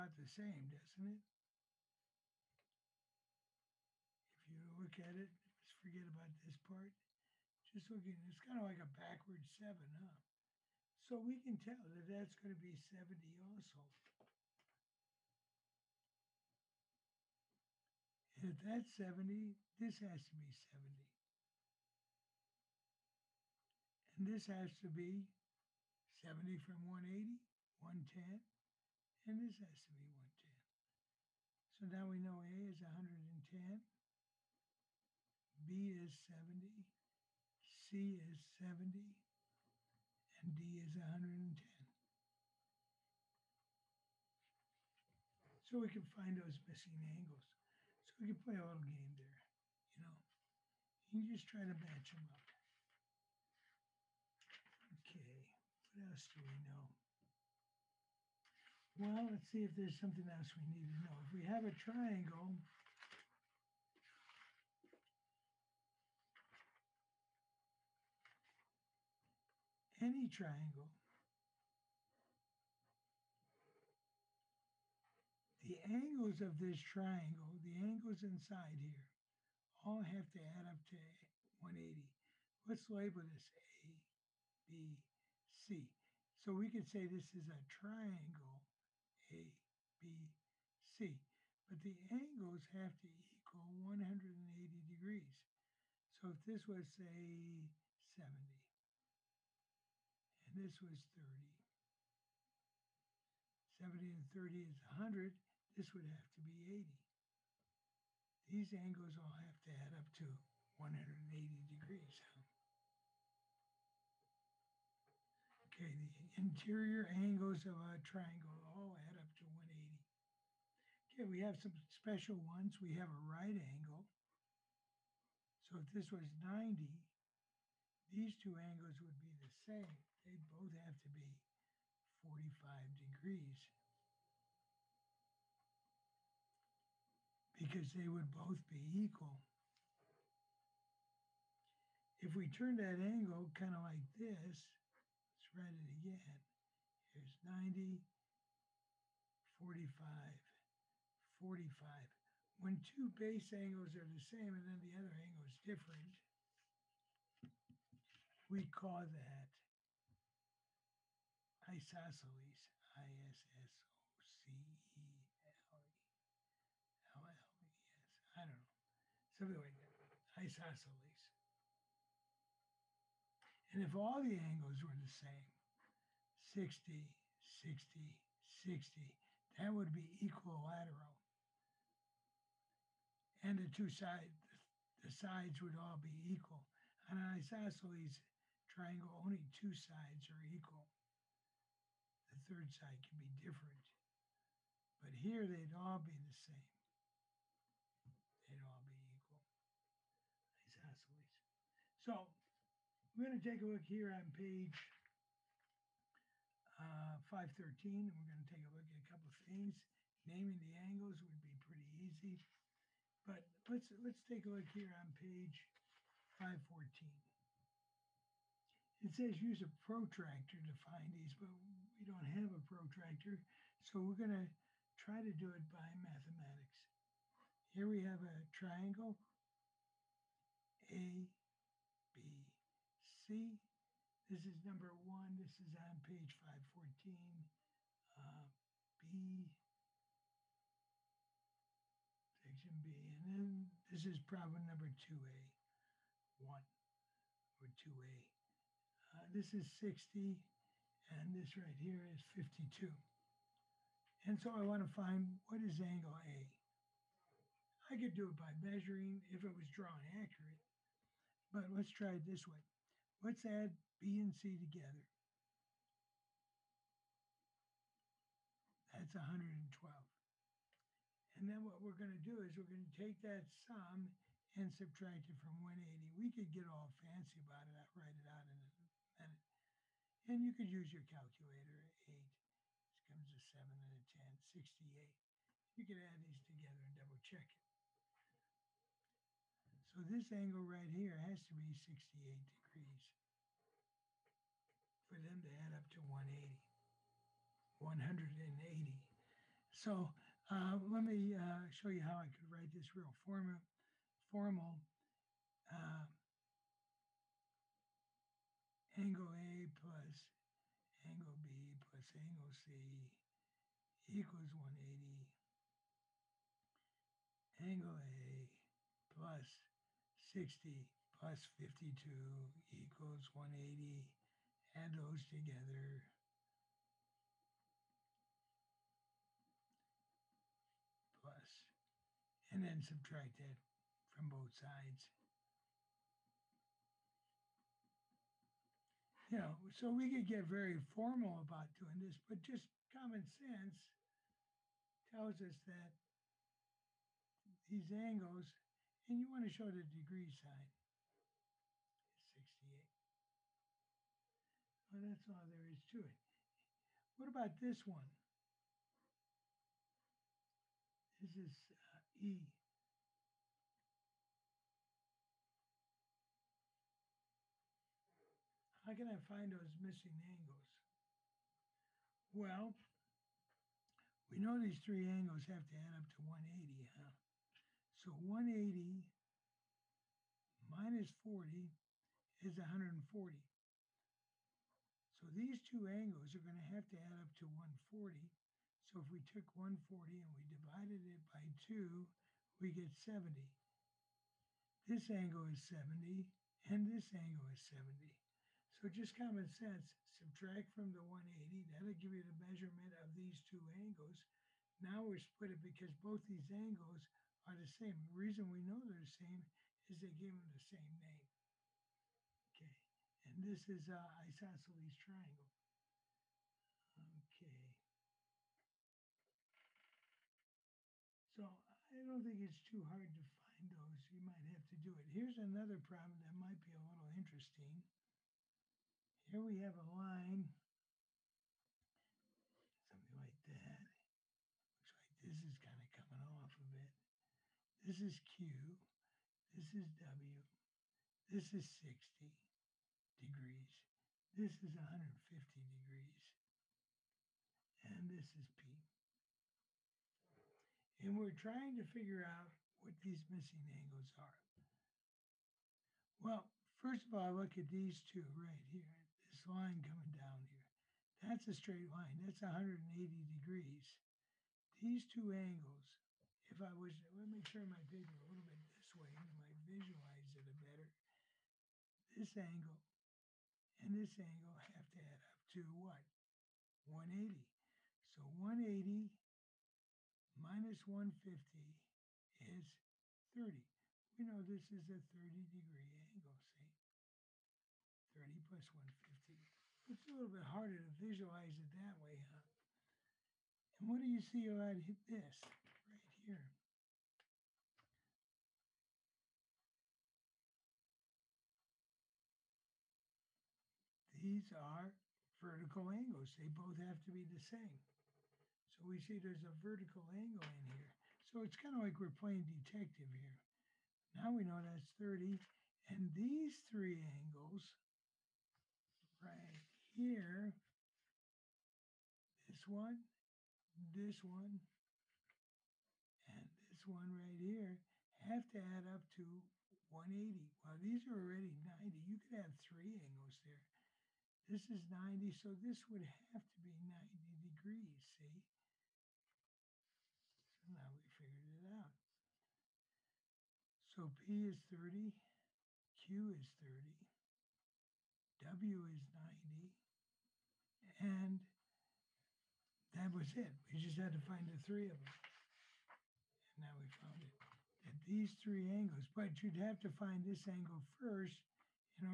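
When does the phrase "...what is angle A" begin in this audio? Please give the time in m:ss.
4:15.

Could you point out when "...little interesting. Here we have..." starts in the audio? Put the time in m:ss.
7:06.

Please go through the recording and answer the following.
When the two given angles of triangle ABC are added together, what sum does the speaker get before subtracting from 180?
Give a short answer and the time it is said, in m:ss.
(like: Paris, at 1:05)
112, at 4:28.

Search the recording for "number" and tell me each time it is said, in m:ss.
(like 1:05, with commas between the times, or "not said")
3:54, 4:04.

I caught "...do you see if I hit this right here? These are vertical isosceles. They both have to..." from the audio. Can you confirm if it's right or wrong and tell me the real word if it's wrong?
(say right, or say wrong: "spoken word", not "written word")
wrong: "angles", not "isosceles".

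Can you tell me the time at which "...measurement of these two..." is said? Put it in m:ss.
6:42.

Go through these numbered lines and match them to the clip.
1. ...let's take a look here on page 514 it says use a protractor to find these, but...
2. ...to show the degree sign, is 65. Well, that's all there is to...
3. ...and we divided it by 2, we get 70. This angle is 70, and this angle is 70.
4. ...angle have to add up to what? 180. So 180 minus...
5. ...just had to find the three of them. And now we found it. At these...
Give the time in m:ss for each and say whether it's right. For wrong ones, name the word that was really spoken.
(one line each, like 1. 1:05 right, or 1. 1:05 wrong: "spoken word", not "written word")
1. 3:33 right
2. 5:49 wrong: "68", not "65"
3. 6:30 right
4. 7:54 right
5. 9:13 right.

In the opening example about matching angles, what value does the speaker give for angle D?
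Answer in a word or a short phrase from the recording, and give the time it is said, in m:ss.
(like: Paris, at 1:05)
110, at 0:40.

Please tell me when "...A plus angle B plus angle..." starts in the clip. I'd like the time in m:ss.
5:09.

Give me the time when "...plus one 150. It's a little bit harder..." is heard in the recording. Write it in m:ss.
8:08.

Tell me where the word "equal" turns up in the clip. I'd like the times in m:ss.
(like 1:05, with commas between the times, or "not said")
1:33, 2:18, 3:06, 3:10, 3:19, 5:14, 5:22.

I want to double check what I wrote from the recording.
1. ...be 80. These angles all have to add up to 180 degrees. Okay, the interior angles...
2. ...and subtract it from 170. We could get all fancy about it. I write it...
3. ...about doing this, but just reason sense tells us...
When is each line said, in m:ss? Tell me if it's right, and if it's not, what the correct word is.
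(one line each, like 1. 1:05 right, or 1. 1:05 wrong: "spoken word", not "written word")
1. 1:46 right
2. 4:34 wrong: "180", not "170"
3. 5:41 wrong: "common", not "reason".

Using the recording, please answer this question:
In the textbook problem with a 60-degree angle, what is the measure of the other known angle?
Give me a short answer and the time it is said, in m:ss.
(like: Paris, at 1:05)
52, at 4:11.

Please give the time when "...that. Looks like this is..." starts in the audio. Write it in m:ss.
7:13.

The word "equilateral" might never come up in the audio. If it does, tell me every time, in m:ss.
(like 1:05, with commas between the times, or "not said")
3:00.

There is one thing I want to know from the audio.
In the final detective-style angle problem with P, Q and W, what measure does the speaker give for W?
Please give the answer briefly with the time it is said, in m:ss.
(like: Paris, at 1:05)
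90, at 9:08.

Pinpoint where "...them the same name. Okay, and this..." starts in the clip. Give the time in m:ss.
6:50.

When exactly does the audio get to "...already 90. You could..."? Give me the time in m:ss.
8:51.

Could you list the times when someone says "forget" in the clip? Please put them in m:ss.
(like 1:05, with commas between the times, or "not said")
0:05.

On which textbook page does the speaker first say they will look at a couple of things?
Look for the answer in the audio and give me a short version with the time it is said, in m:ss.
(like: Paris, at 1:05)
513, at 3:27.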